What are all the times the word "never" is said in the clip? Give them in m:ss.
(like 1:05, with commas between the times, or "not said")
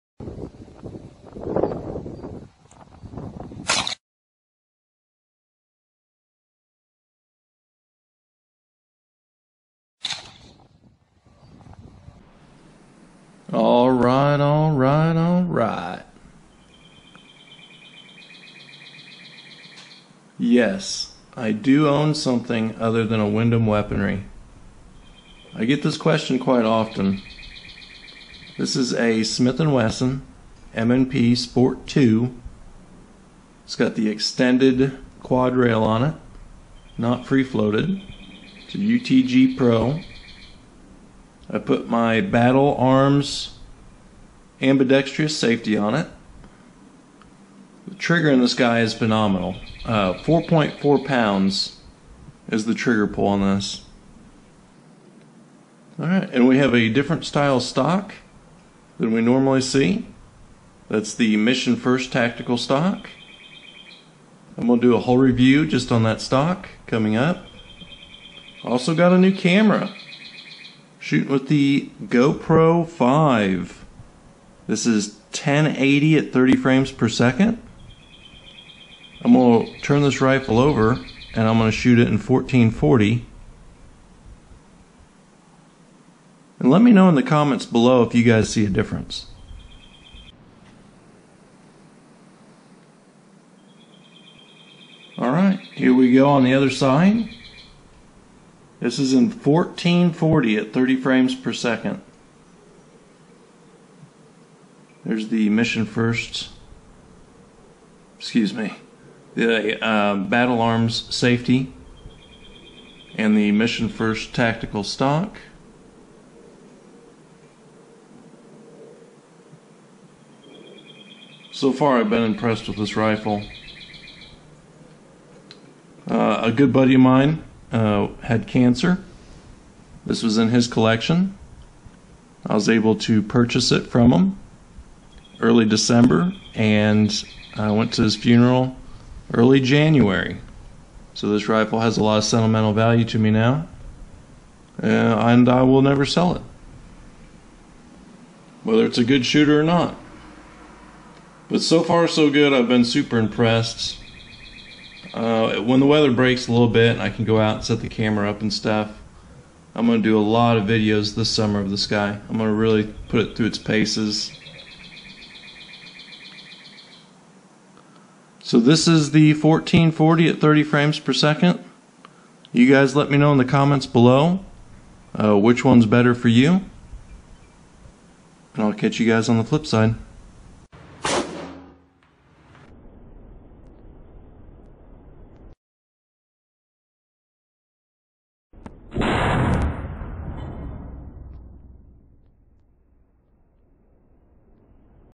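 2:25.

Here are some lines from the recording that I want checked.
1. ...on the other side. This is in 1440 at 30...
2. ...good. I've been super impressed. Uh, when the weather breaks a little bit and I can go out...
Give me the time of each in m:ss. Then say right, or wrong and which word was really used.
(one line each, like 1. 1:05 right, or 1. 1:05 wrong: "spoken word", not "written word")
1. 1:36 right
2. 2:32 right.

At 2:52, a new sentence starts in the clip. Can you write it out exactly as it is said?
You guys let me know in the comments below uh, which one's better for you.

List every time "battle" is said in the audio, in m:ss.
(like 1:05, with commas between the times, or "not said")
0:42, 1:50.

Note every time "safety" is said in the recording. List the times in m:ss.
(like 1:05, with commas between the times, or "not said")
0:45, 1:51.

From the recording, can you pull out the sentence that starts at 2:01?
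So far, I've been impressed with this rifle.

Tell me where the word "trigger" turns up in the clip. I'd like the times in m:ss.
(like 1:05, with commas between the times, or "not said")
0:47, 0:52.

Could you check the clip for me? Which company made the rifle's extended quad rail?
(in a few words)
UTG Pro.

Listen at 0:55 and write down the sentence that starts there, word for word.
Alright, and we have a different style stock than we normally see.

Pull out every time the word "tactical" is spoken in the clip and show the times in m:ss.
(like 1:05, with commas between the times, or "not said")
1:02, 1:54.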